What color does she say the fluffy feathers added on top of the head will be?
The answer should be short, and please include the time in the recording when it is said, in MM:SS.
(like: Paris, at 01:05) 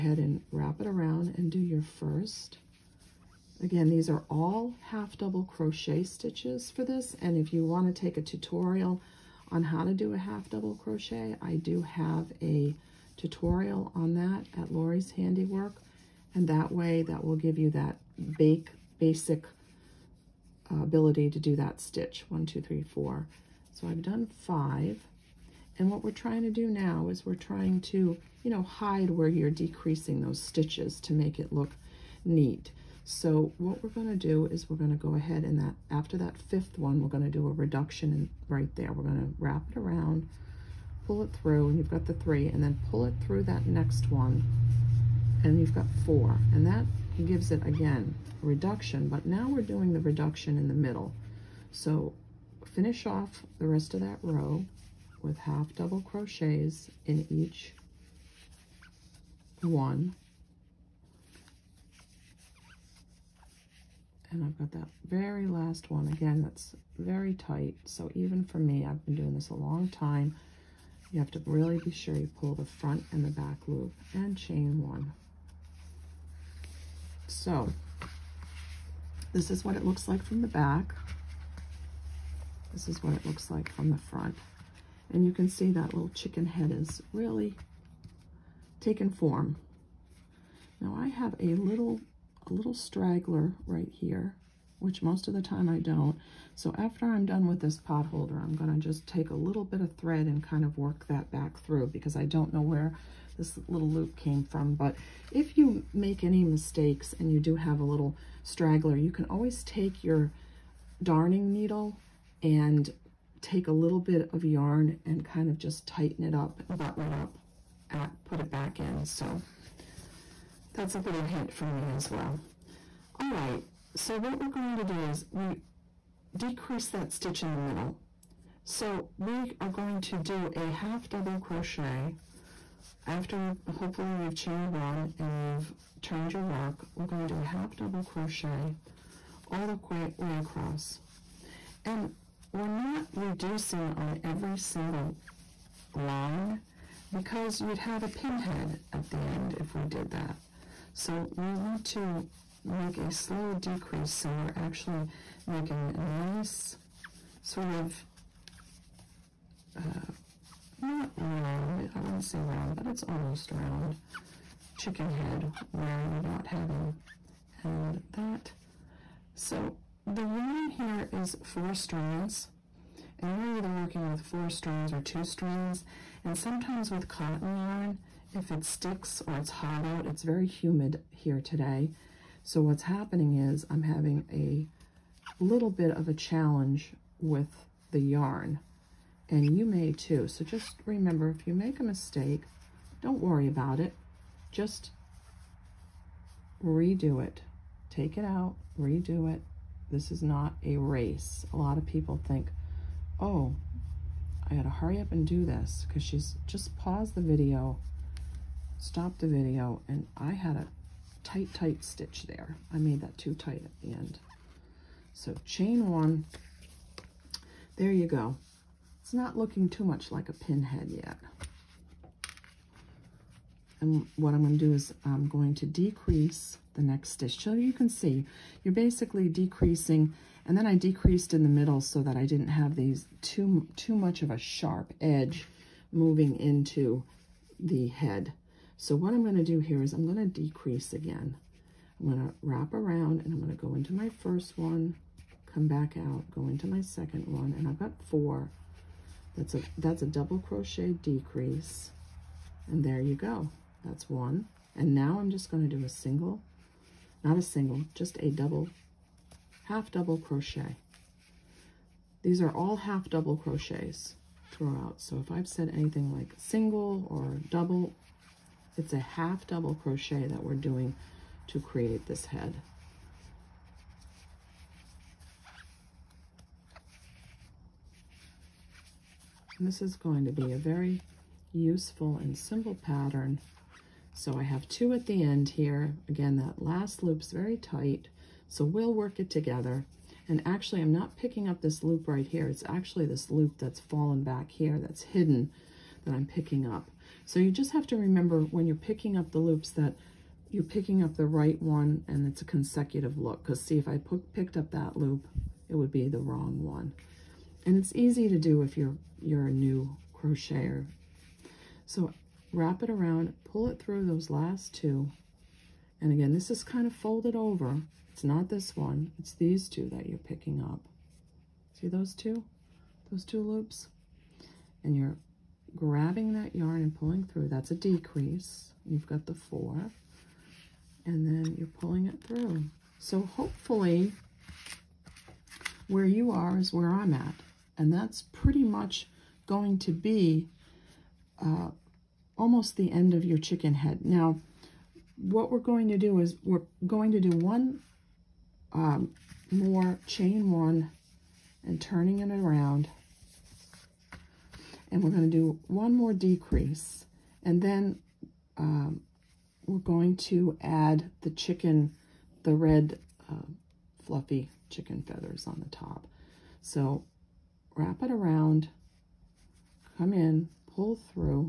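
red, at 06:02.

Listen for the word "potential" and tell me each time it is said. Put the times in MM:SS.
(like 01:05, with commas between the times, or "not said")
not said.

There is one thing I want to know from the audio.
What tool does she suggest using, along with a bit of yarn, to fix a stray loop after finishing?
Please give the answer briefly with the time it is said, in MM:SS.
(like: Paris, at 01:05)
darning needle, at 01:51.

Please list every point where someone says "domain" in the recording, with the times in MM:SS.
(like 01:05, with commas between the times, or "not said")
not said.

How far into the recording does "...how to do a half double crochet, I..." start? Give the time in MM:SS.
00:09.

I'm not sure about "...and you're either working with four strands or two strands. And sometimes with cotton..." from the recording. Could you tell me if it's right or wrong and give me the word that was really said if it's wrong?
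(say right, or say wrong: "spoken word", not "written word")
right.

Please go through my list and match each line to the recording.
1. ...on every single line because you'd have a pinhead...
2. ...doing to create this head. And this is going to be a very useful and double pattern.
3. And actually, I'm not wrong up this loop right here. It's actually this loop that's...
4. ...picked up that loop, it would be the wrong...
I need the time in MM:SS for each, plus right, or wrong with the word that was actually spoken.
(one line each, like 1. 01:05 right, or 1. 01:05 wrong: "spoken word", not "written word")
1. 02:23 right
2. 04:30 wrong: "simple", not "double"
3. 04:50 wrong: "picking", not "wrong"
4. 05:04 right.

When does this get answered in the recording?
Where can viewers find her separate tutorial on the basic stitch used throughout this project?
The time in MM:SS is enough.
00:14.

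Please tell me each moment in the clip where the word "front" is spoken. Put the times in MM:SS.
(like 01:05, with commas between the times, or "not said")
01:12, 01:23.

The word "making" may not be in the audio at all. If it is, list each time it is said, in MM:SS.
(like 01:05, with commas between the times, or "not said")
02:35.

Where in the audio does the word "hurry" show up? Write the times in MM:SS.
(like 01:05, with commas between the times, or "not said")
03:24.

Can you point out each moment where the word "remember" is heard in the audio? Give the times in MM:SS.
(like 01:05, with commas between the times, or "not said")
03:10, 04:57.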